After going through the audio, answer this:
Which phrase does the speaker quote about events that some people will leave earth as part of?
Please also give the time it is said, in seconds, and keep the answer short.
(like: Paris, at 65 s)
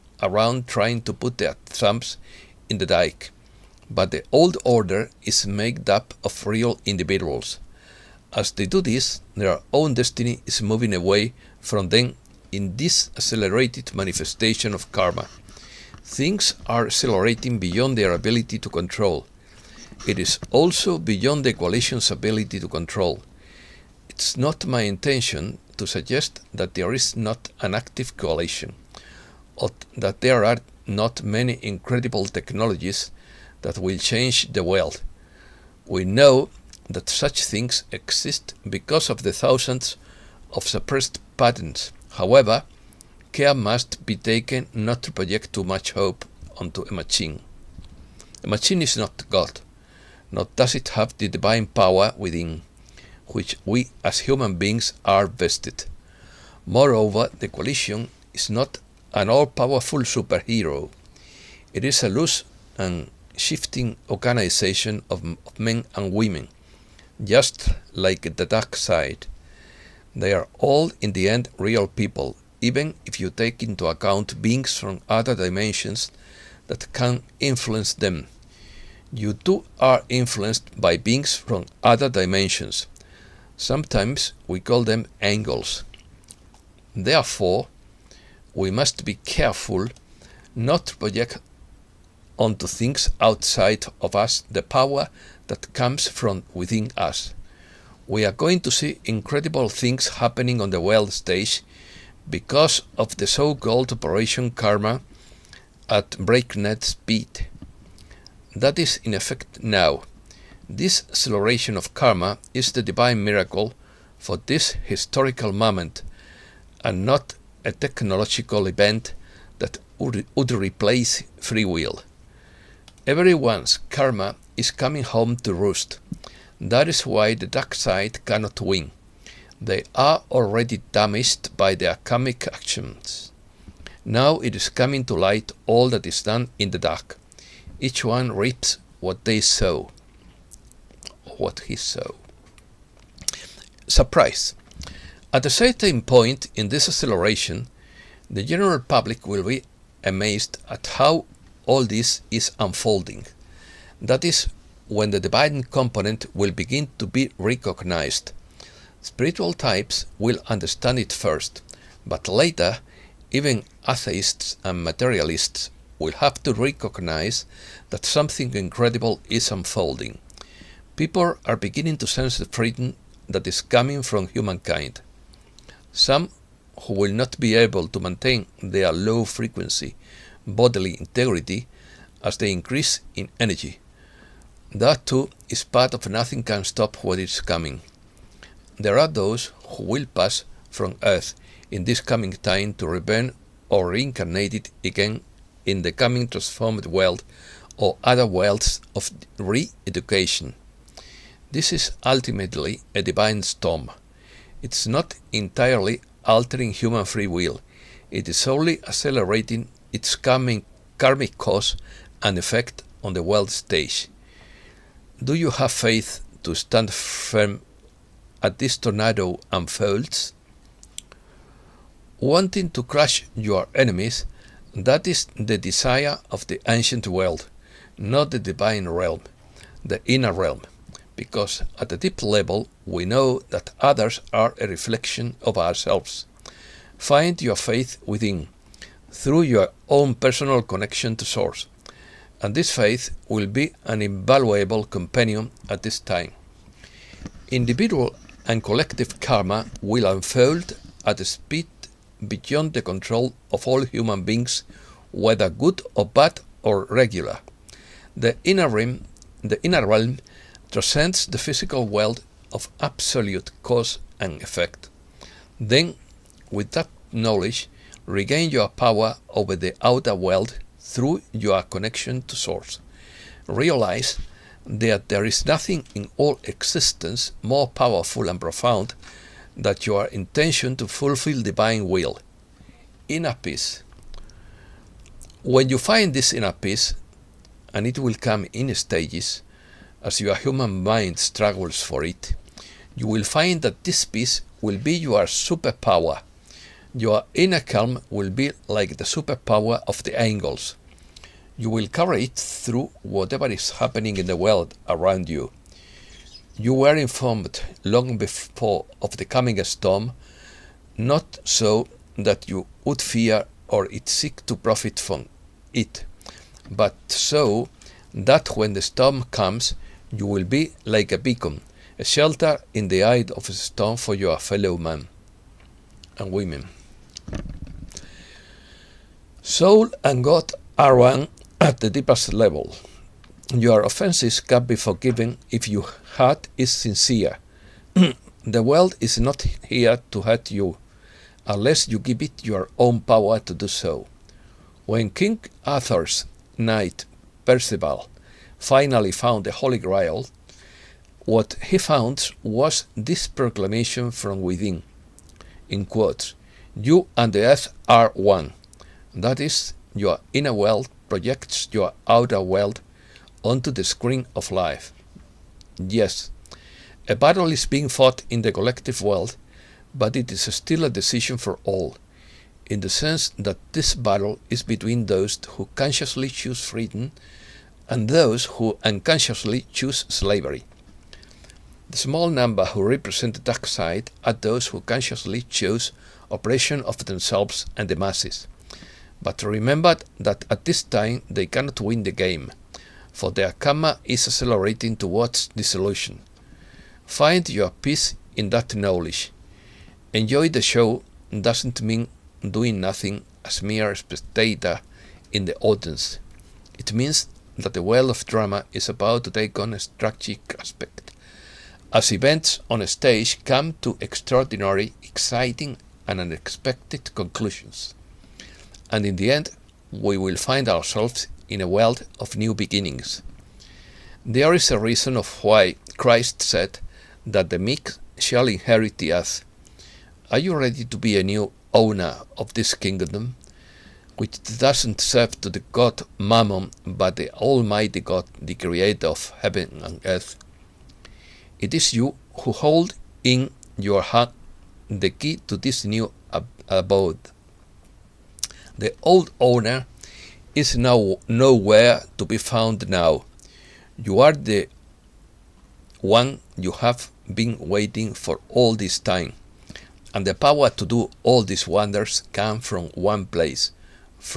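Nothing Can Stop What Is Coming, at 186 s.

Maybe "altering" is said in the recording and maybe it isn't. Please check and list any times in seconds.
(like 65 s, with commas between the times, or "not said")
206 s.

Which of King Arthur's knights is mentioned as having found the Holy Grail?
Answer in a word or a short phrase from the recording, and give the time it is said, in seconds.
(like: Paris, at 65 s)
Percival, at 347 s.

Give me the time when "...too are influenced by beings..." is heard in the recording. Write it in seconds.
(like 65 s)
79 s.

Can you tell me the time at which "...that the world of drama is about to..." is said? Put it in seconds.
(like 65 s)
407 s.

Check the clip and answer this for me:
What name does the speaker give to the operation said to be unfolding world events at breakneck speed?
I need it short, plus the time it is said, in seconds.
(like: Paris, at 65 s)
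Operation Karma, at 103 s.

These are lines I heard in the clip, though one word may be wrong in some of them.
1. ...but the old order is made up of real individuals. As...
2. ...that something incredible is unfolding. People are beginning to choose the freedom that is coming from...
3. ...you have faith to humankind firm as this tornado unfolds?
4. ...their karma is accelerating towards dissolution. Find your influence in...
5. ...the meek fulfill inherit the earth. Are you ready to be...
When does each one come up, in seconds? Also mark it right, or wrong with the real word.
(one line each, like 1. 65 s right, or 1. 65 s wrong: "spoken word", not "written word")
1. 3 s right
2. 167 s wrong: "sense", not "choose"
3. 215 s wrong: "stand", not "humankind"
4. 393 s wrong: "peace", not "influence"
5. 427 s wrong: "shall", not "fulfill".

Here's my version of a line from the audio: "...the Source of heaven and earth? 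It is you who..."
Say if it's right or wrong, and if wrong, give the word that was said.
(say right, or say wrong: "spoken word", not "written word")
wrong: "Creator", not "Source".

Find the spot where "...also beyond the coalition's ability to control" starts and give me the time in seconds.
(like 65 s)
20 s.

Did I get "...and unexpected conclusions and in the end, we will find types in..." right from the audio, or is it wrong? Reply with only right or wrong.
wrong.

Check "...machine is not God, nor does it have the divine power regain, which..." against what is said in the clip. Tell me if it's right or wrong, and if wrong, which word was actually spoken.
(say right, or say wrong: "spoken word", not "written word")
wrong: "within", not "regain".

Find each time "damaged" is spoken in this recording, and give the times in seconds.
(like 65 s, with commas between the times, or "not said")
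130 s.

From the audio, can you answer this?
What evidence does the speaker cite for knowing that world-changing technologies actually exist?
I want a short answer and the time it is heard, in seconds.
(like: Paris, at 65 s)
Thousands of suppressed patents, at 39 s.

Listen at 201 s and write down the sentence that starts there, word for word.
This is ultimately a divine storm.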